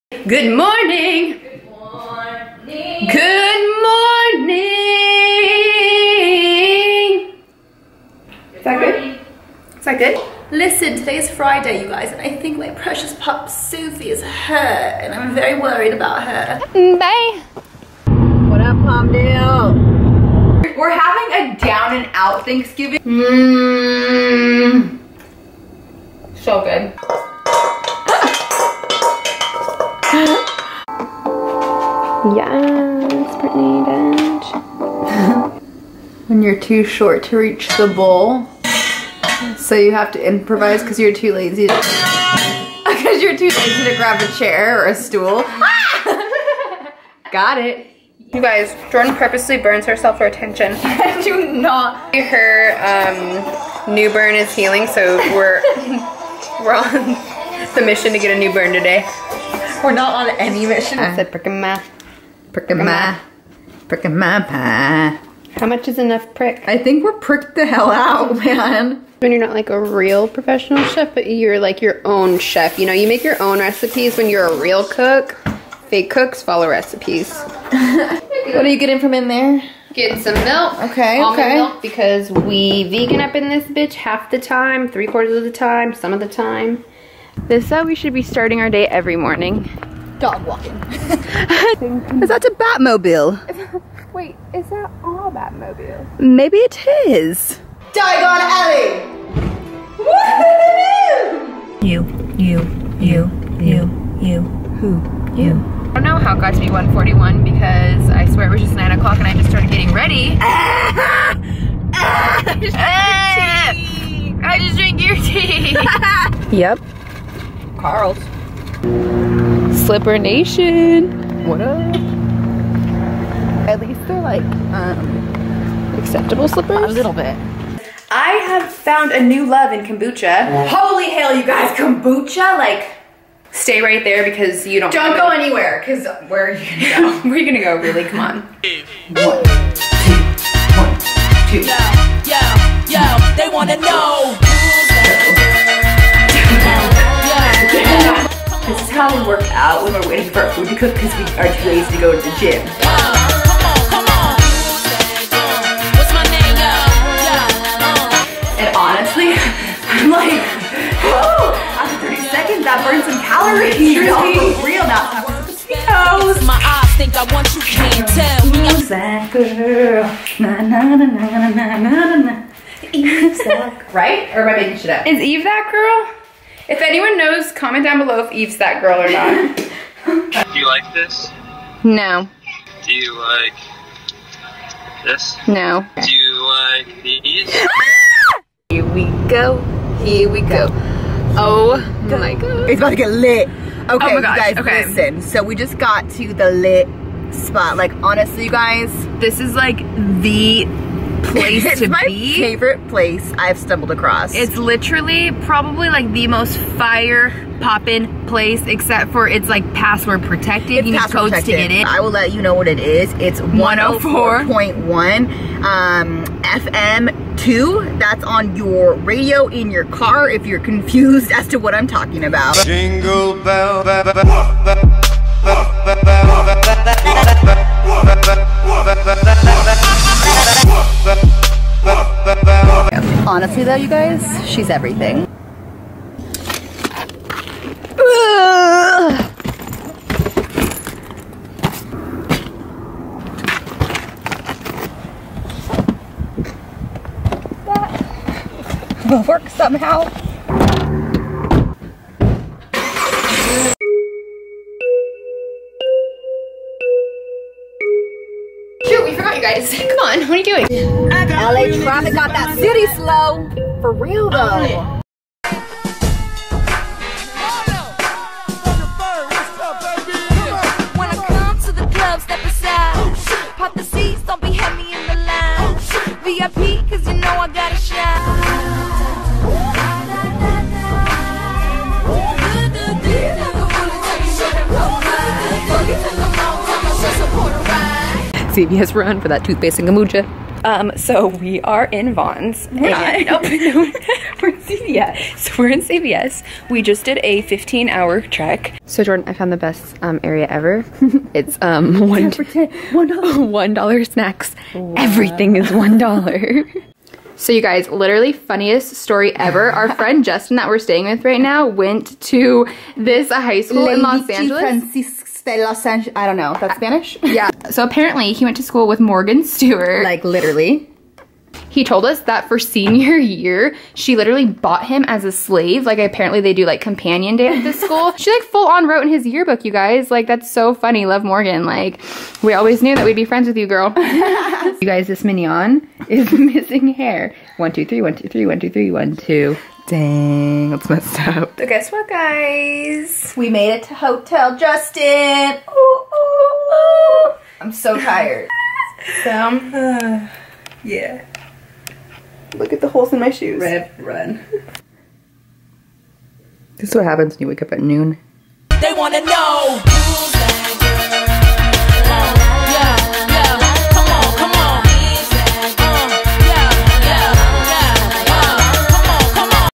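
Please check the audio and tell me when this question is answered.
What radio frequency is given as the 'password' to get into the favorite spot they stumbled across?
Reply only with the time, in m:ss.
3:33.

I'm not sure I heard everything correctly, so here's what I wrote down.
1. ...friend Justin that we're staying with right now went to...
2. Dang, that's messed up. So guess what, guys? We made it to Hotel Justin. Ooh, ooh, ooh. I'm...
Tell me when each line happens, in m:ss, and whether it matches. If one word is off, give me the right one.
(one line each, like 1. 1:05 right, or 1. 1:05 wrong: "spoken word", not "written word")
1. 5:09 right
2. 5:39 right.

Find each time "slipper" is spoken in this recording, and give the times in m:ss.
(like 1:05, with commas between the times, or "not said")
1:59, 2:06.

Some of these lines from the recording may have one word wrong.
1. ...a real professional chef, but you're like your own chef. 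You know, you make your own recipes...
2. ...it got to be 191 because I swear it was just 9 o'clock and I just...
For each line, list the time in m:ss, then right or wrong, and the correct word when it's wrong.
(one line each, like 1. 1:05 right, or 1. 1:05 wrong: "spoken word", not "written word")
1. 1:09 right
2. 1:46 wrong: "141", not "191".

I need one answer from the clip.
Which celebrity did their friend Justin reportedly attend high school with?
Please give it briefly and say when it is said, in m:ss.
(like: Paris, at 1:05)
Morgan Stewart, at 5:18.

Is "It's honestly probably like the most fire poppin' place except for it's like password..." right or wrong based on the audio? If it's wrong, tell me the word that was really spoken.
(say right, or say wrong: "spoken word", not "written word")
wrong: "literally", not "honestly".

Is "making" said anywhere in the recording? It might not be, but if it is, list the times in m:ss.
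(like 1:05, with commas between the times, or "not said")
2:54.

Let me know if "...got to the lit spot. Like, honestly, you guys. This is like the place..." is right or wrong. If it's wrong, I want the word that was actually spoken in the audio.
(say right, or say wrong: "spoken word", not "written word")
right.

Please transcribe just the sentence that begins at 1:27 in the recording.
This is uh, how we should be starting our day every morning.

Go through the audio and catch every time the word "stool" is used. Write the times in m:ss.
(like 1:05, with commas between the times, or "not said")
0:44.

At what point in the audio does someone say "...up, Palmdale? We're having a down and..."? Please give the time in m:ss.
0:18.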